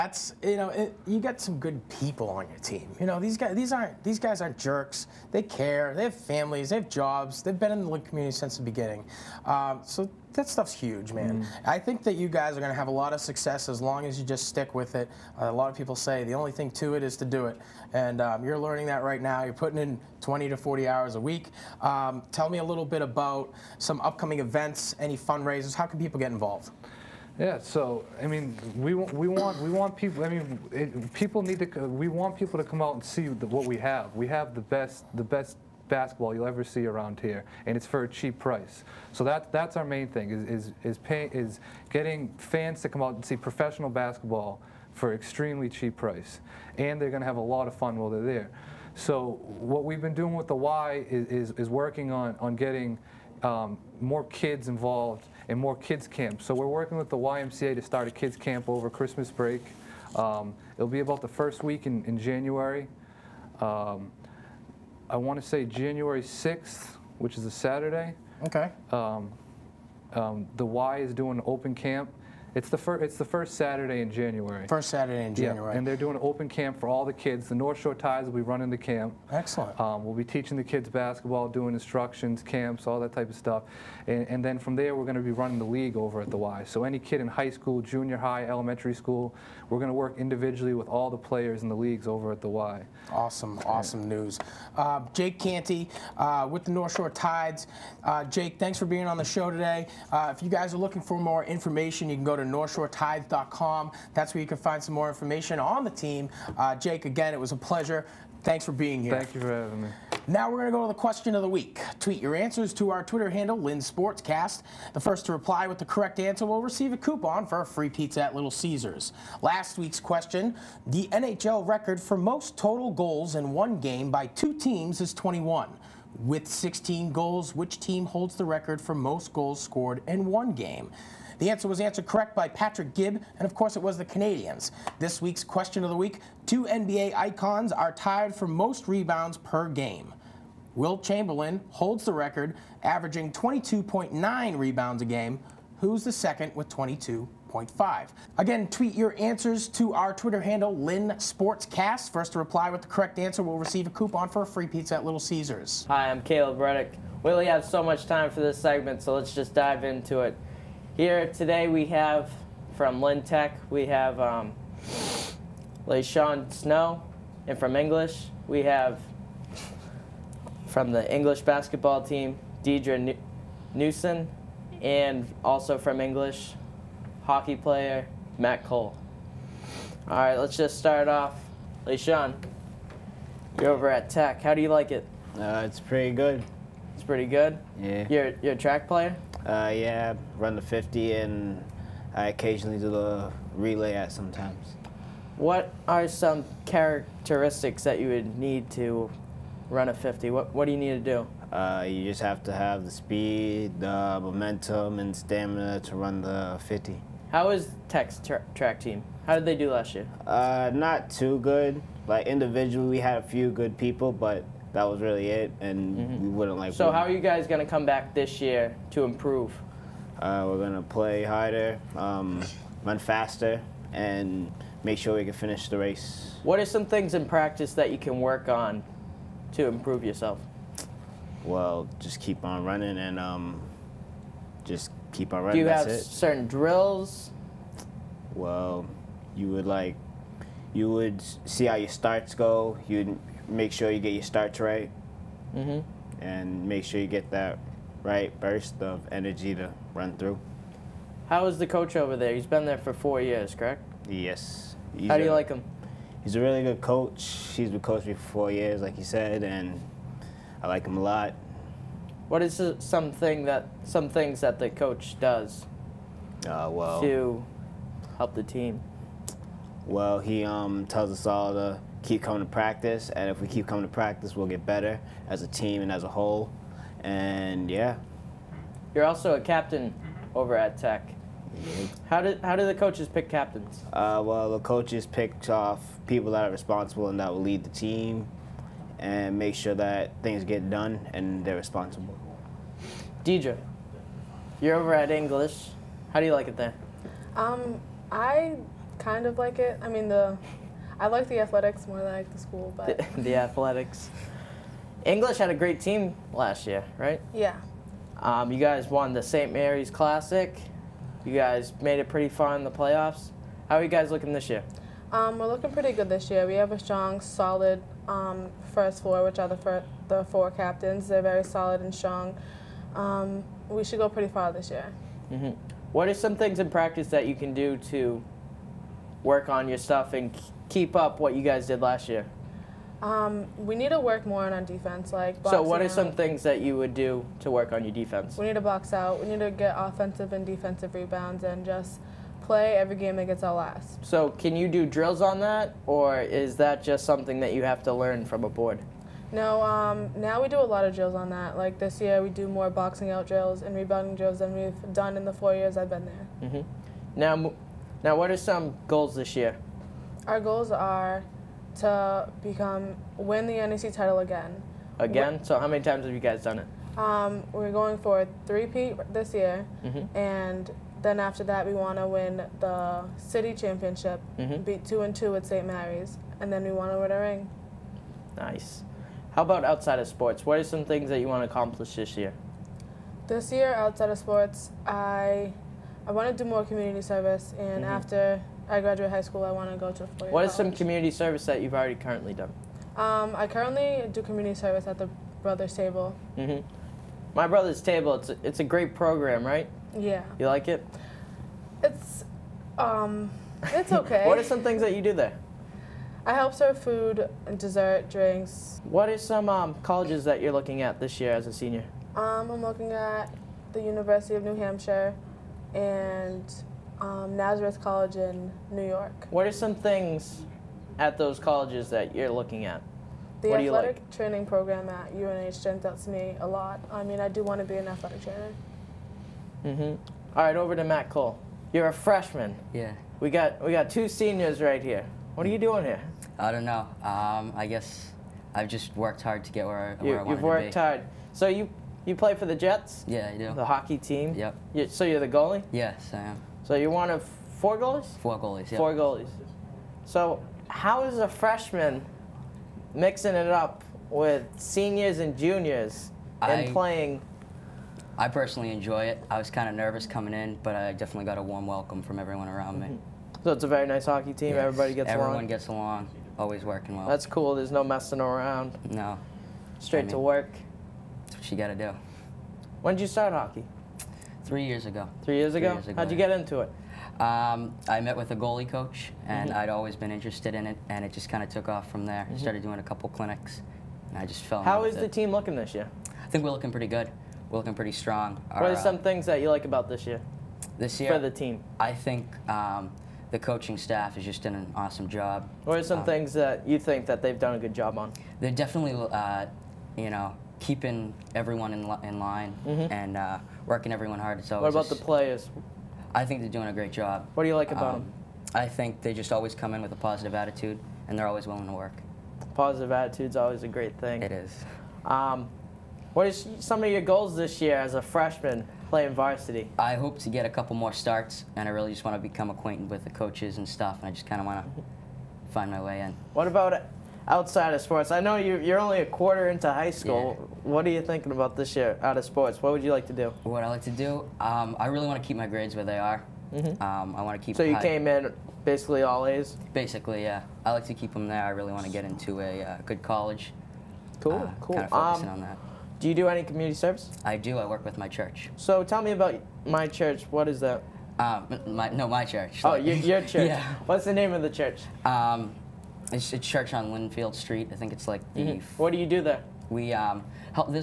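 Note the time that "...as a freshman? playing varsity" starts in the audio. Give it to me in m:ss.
8:37.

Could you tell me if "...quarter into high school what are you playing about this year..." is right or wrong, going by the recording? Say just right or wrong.
wrong.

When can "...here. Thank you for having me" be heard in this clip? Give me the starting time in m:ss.
1:49.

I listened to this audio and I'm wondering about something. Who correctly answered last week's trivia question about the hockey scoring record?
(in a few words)
Patrick Gibb.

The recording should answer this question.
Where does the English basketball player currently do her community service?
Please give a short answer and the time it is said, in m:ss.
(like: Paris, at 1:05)
My Brothers Table, at 6:34.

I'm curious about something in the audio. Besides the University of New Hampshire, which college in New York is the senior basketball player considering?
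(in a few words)
Nazareth College.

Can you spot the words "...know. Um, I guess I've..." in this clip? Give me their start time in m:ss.
7:16.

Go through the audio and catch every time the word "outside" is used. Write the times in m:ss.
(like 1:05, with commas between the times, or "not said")
6:19, 6:23, 8:47.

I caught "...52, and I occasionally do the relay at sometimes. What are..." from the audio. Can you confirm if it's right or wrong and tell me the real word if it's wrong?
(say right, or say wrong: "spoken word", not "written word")
wrong: "50", not "52".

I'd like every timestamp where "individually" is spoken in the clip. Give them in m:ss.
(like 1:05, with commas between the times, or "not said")
1:30, 3:32.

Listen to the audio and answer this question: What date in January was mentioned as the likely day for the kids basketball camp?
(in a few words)
January 6.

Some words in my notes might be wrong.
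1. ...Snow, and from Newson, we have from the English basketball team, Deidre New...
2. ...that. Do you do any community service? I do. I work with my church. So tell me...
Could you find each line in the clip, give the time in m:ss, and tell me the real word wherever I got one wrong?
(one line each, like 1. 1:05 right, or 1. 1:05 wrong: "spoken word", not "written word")
1. 2:46 wrong: "English", not "Newson"
2. 9:05 right.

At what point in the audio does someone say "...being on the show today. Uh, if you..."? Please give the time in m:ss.
1:38.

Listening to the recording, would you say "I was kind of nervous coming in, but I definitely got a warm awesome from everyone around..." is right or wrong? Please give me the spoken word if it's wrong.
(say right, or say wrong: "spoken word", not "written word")
wrong: "welcome", not "awesome".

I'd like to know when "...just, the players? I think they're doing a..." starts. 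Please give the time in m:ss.
8:24.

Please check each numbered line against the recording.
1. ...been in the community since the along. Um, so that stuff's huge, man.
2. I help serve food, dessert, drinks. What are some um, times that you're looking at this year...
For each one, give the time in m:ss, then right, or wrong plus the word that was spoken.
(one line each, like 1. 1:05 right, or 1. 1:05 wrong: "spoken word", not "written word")
1. 0:07 wrong: "beginning", not "along"
2. 6:46 wrong: "colleges", not "times".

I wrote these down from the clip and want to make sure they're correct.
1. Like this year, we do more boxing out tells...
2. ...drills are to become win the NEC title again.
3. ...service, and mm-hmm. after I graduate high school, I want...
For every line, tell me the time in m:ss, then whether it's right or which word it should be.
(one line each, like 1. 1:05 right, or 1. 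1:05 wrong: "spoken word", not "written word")
1. 5:51 wrong: "drills", not "tells"
2. 6:00 wrong: "goals", not "drills"
3. 6:26 right.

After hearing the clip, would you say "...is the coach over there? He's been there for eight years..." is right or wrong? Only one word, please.
wrong.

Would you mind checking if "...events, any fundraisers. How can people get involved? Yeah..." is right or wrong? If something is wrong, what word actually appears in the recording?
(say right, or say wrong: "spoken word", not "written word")
right.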